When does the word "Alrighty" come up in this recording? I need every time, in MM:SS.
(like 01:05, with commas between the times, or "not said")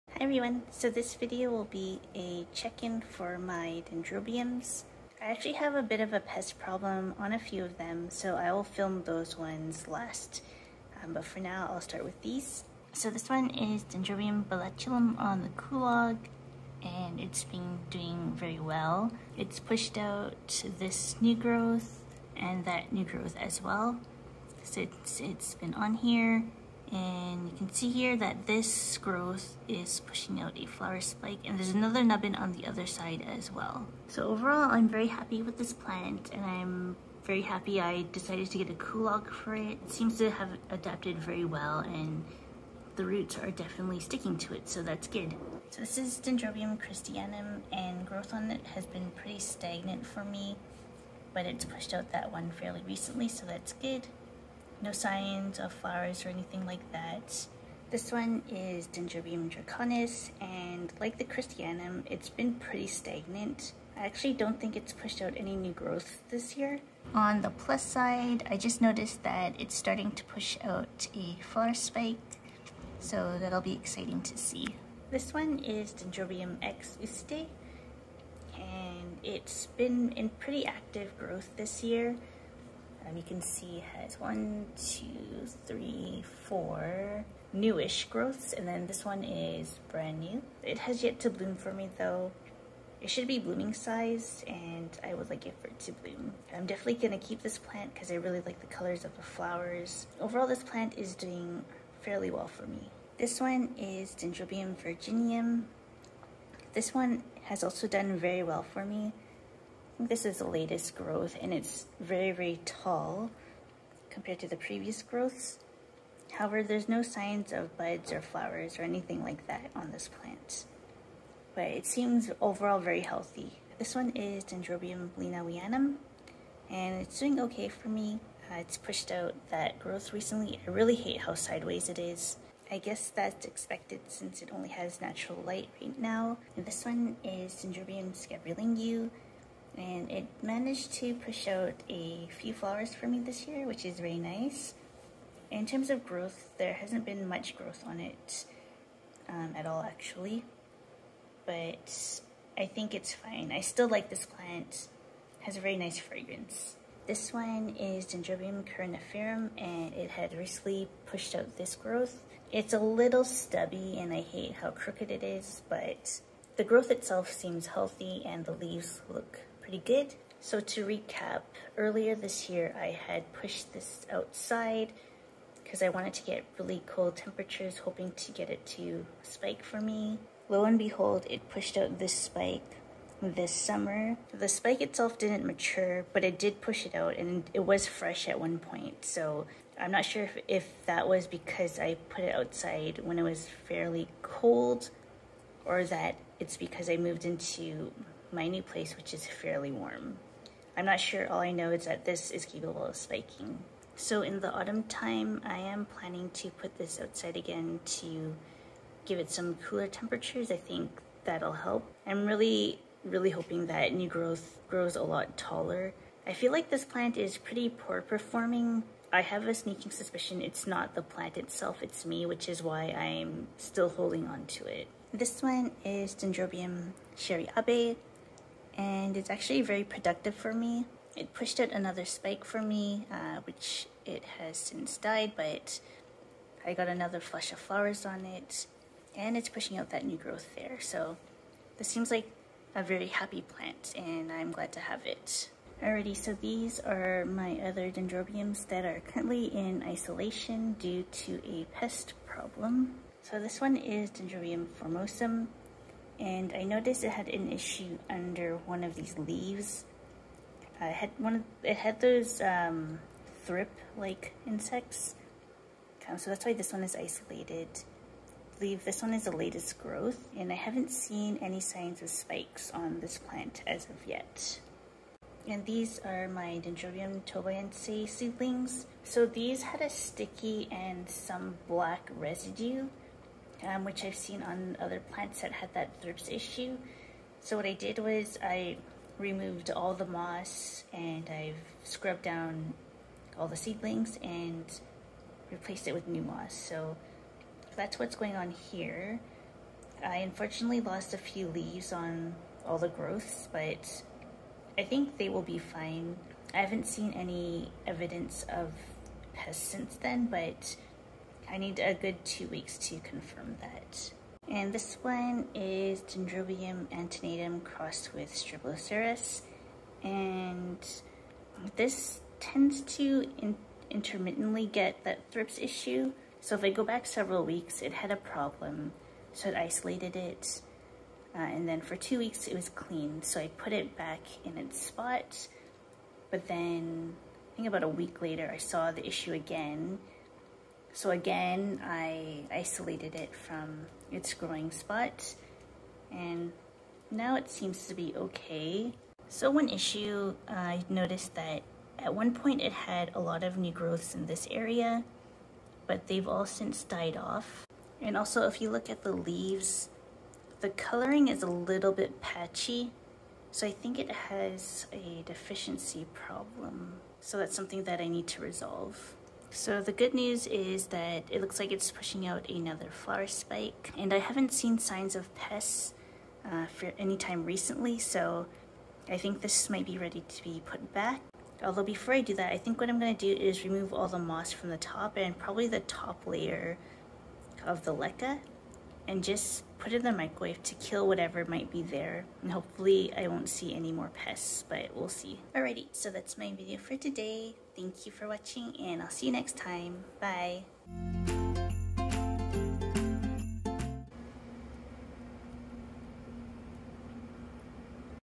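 04:05, 06:35.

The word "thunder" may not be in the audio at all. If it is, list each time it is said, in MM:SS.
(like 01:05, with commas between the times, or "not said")
not said.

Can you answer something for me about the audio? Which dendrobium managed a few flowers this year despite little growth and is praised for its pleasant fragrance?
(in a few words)
Dendrobium scabrilingue.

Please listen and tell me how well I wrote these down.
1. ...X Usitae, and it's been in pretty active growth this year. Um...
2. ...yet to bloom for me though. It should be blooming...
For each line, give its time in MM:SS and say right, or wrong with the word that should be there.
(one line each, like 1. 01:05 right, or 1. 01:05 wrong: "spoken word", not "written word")
1. 01:16 right
2. 01:31 right.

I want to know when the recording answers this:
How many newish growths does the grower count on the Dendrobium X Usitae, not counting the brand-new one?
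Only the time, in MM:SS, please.
01:26.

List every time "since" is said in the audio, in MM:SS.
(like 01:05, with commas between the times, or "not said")
00:24, 02:14, 03:54, 05:09, 05:56.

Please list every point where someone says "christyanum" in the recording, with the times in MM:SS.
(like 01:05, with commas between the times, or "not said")
00:46, 01:01.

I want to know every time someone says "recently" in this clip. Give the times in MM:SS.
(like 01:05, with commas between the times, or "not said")
00:52, 02:10, 02:40, 06:17.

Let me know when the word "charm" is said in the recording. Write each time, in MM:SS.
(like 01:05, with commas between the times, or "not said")
not said.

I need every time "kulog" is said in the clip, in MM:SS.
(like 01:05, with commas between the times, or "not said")
00:15, 00:38.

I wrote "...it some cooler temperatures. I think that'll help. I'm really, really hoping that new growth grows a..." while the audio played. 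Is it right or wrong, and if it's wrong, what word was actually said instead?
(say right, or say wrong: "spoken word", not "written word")
right.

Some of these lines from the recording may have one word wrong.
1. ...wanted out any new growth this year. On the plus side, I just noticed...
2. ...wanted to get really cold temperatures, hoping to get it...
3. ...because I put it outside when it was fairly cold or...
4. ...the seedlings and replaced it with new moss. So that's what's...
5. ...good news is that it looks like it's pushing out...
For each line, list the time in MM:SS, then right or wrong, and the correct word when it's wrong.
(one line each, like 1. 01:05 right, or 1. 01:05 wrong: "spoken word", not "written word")
1. 01:04 wrong: "pushed", not "wanted"
2. 02:55 right
3. 03:11 right
4. 04:53 right
5. 06:09 right.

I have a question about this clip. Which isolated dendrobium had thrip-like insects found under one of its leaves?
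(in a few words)
Dendrobium formosum.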